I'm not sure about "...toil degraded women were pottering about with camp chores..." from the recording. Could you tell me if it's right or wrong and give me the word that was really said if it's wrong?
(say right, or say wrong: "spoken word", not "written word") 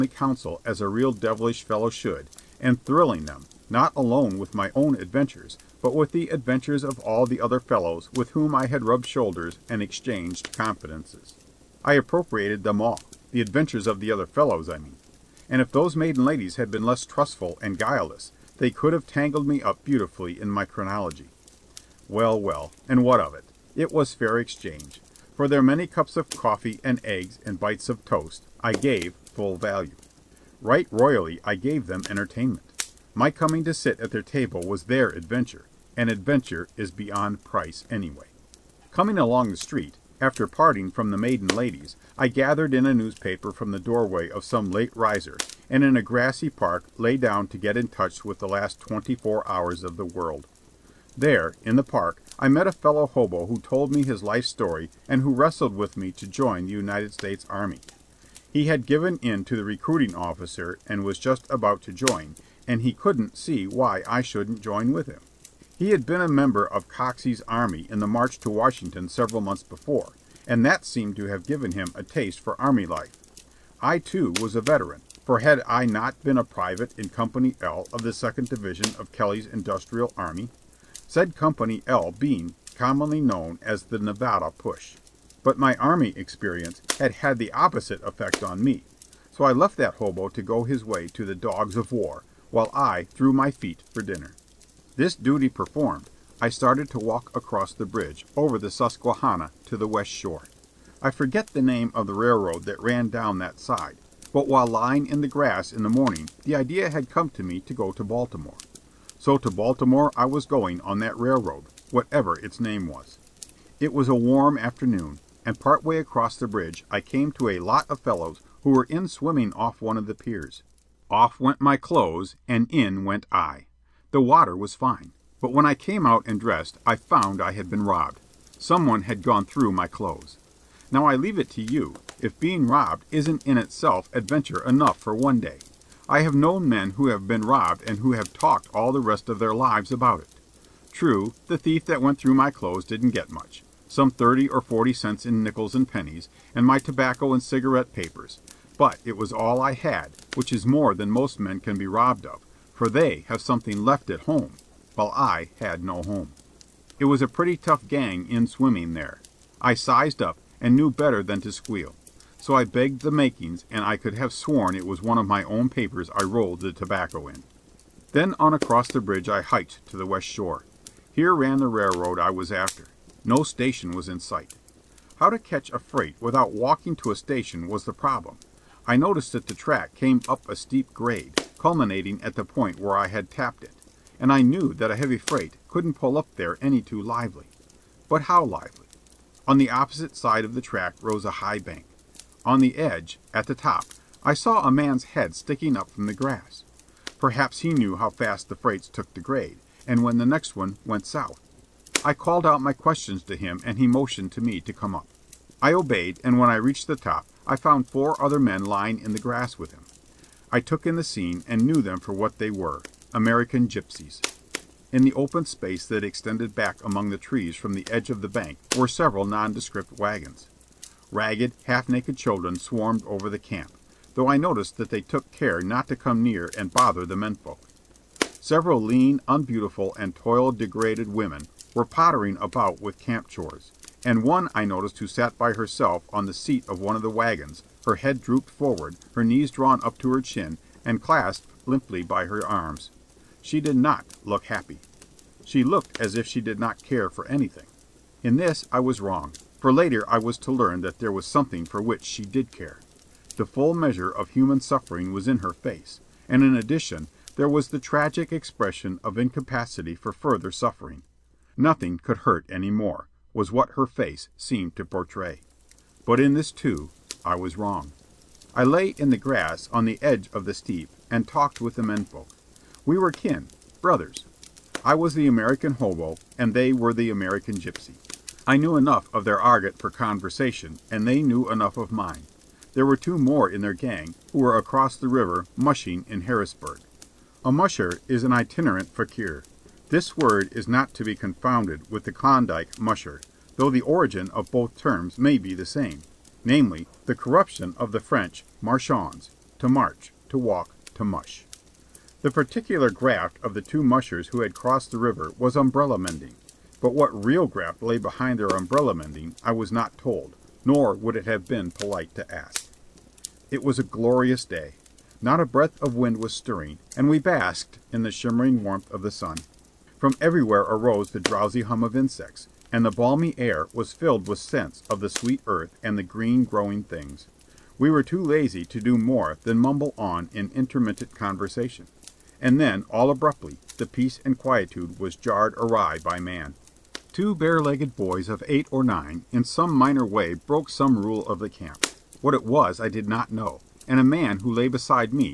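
right.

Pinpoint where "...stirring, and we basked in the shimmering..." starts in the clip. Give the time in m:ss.
5:16.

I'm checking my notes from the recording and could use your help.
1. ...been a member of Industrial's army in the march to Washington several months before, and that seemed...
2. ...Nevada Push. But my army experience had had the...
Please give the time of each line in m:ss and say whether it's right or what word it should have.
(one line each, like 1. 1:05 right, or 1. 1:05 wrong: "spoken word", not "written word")
1. 1:06 wrong: "Coxey", not "Industrial"
2. 1:23 right.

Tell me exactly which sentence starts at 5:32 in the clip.
And then, all abruptly, the peace and quietude was jarred awry by man.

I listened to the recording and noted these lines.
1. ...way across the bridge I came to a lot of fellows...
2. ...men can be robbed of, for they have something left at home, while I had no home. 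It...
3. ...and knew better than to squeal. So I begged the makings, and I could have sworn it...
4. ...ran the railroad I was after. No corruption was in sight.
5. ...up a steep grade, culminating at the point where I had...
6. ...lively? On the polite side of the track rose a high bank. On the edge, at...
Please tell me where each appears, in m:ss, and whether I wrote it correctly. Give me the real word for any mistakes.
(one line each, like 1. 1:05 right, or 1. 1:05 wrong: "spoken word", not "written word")
1. 1:55 right
2. 2:31 right
3. 2:40 right
4. 2:51 wrong: "station", not "corruption"
5. 3:00 right
6. 3:08 wrong: "opposite", not "polite".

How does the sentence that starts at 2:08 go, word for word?
Someone had gone through my clothes.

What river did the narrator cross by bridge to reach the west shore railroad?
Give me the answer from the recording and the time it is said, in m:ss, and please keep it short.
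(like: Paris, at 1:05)
Susquehanna, at 1:38.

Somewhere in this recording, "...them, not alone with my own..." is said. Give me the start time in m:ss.
0:03.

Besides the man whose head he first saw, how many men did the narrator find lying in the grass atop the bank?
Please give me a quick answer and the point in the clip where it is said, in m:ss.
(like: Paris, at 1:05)
4, at 3:27.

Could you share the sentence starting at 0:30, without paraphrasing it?
Right royally I gave them entertainment.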